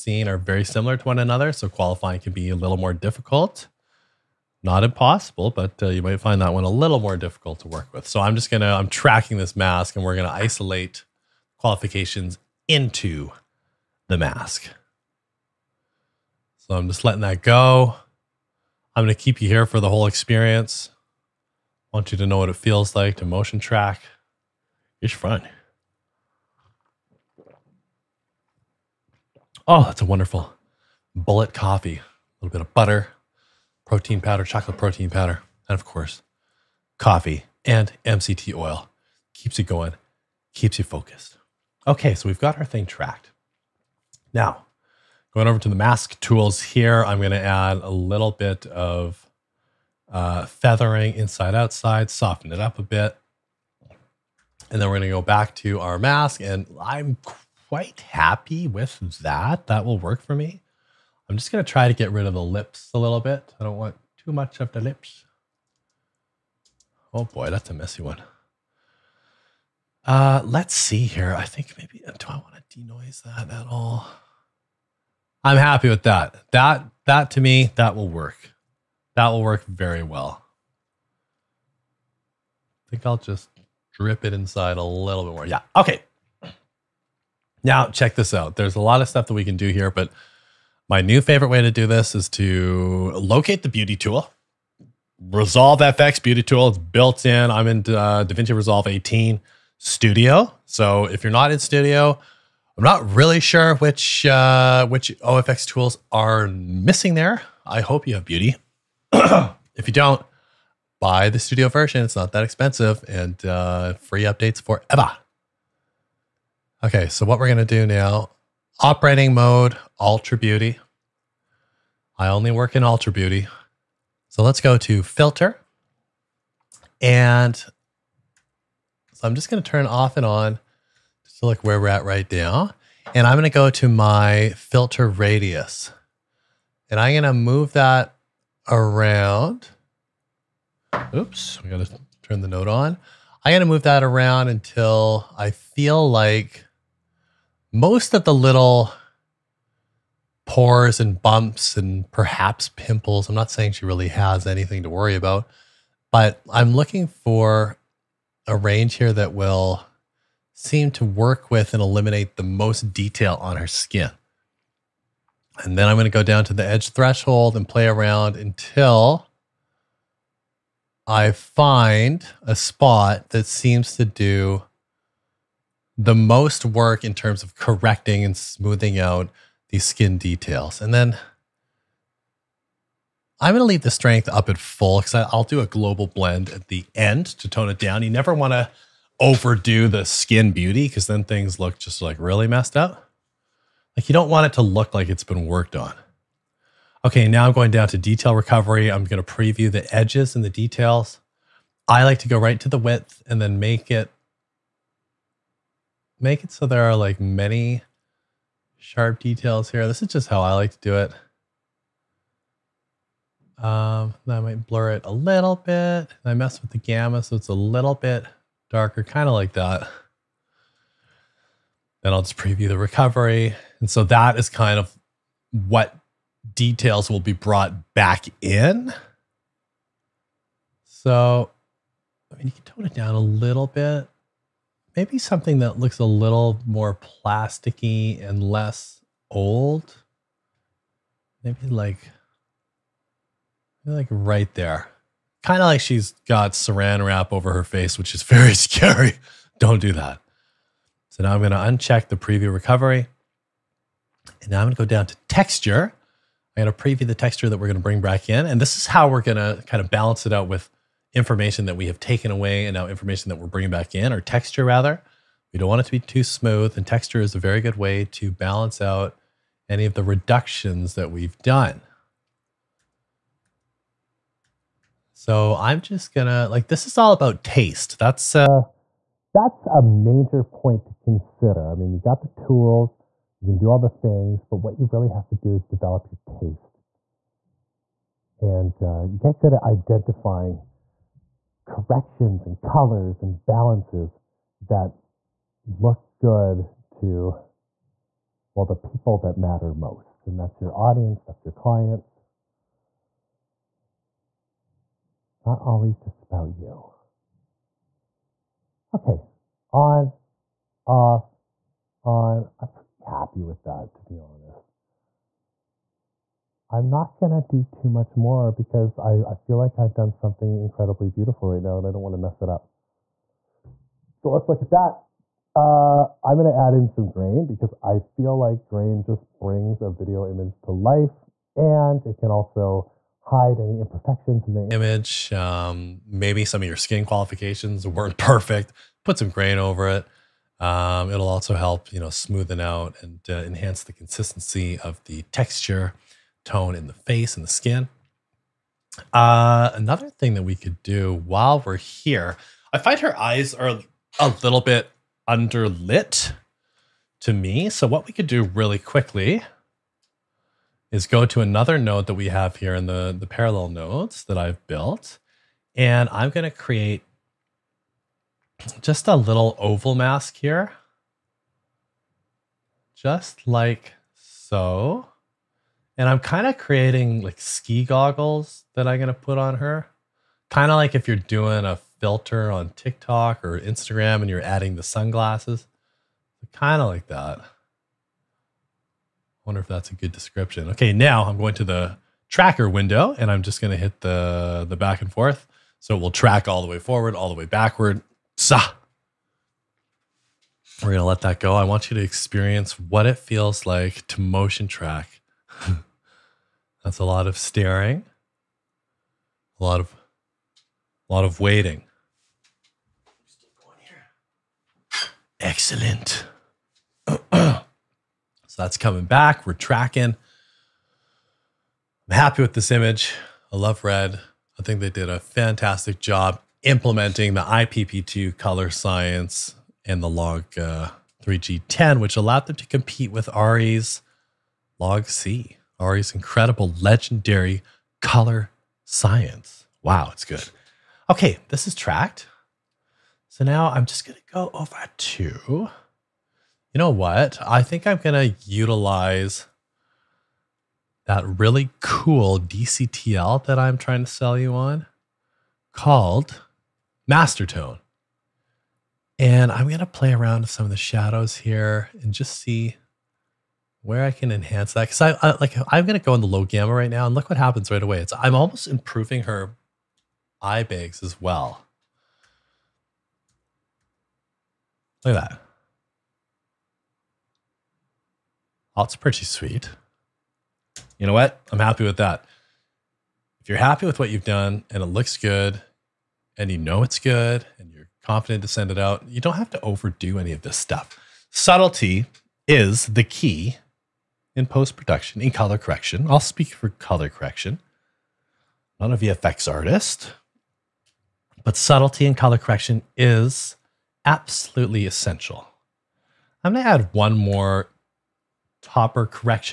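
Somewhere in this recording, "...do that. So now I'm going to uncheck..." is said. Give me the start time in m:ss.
4:09.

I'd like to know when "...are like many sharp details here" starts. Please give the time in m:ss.
3:26.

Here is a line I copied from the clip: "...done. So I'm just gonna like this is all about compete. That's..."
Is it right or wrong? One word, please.
wrong.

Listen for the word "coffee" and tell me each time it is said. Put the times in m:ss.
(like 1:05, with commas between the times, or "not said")
0:31, 0:36.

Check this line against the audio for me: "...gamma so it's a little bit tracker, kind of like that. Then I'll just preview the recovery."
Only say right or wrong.
wrong.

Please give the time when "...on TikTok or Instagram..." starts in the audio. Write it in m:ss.
6:22.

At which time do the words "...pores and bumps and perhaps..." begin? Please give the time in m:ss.
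2:30.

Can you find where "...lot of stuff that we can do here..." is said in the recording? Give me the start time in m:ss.
1:28.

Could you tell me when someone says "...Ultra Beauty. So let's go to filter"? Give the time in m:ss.
2:02.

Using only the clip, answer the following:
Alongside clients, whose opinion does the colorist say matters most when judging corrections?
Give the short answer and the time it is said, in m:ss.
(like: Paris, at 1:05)
Your audience, at 5:00.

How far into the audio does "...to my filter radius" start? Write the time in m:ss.
2:13.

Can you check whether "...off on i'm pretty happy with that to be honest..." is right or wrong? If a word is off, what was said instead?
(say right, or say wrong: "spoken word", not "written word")
right.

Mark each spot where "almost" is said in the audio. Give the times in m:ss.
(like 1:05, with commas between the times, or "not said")
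7:48.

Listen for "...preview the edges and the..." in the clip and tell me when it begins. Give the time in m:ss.
3:19.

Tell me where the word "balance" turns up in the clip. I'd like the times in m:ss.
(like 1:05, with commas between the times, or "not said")
4:19, 4:28, 4:53.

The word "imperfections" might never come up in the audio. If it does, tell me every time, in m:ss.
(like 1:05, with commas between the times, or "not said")
5:33.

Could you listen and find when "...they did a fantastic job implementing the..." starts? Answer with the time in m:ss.
7:04.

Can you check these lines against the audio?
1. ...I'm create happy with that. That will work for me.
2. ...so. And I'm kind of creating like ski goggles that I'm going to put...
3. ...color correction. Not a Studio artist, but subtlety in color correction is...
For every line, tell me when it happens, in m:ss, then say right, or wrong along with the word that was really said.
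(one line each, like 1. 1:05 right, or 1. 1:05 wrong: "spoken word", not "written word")
1. 0:56 wrong: "quite", not "create"
2. 6:14 right
3. 8:16 wrong: "VFX", not "Studio".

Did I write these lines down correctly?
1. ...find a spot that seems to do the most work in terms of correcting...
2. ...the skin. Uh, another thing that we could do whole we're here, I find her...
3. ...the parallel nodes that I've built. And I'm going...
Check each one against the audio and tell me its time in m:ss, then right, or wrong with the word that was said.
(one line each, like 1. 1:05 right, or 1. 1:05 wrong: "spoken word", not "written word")
1. 2:51 right
2. 5:47 wrong: "while", not "whole"
3. 6:03 right.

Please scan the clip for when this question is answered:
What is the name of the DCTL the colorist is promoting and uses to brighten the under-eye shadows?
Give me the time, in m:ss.
7:37.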